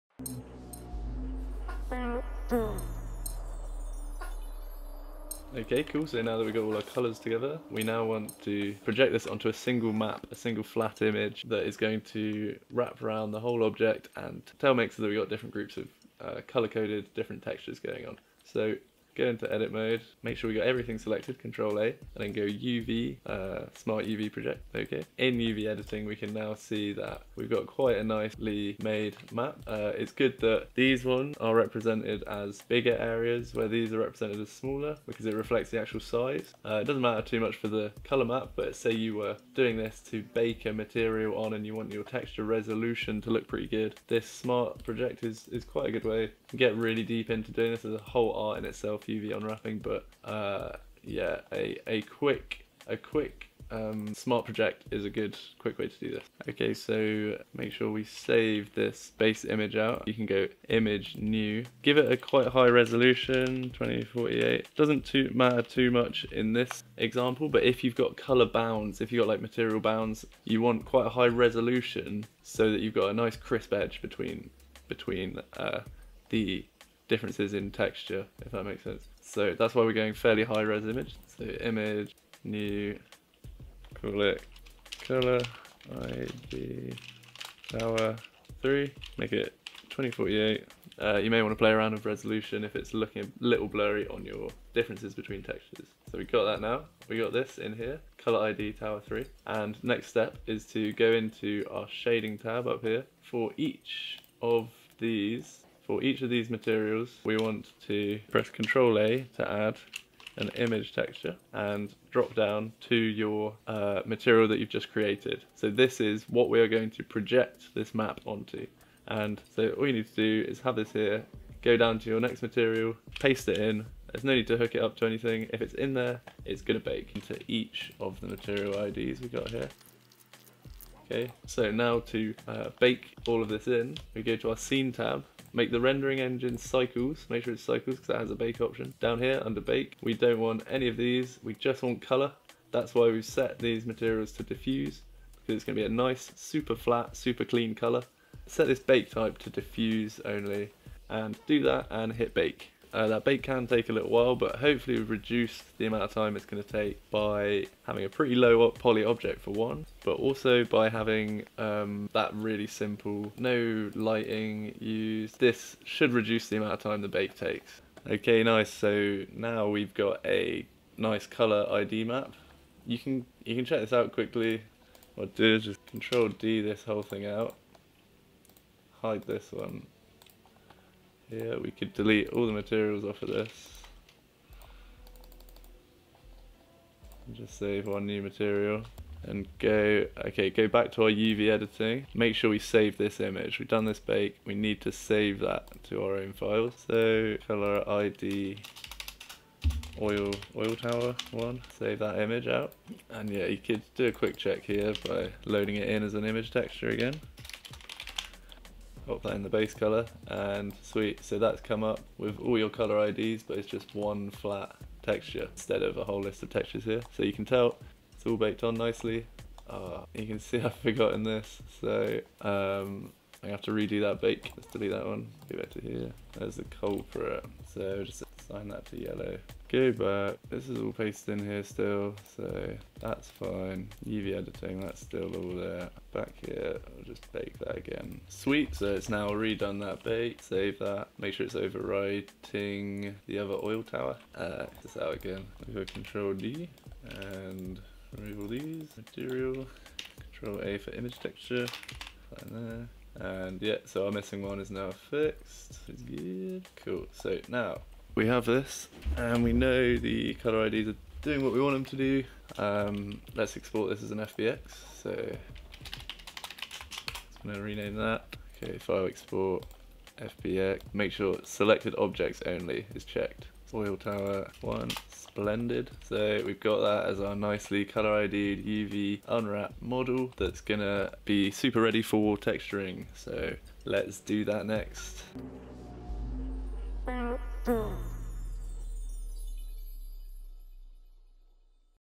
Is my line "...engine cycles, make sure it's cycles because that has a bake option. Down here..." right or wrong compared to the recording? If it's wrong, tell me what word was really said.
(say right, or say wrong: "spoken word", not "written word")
right.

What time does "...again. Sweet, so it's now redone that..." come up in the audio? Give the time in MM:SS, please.
03:57.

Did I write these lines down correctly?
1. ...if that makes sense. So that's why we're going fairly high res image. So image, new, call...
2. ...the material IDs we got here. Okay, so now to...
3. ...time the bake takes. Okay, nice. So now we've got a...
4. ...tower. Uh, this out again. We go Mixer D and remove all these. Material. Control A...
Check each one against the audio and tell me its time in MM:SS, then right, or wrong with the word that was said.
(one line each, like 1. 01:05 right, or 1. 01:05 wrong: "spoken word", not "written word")
1. 01:18 right
2. 02:08 right
3. 02:46 right
4. 04:03 wrong: "Control", not "Mixer".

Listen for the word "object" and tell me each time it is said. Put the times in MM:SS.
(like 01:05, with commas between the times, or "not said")
00:13, 02:39, 04:31.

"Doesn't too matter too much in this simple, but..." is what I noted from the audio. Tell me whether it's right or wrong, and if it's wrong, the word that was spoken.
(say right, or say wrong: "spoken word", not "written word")
wrong: "example", not "simple".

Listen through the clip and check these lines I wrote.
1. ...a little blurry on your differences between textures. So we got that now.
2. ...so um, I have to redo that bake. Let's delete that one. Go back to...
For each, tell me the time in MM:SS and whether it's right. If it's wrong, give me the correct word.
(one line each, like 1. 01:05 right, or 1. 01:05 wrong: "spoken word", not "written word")
1. 01:33 right
2. 03:41 right.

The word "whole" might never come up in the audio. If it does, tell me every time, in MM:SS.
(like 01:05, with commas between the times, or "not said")
00:13, 00:47, 02:56, 03:36.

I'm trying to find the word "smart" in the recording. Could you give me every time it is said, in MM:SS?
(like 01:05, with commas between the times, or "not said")
00:23, 00:44, 00:54.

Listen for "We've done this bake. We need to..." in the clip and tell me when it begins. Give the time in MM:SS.
03:13.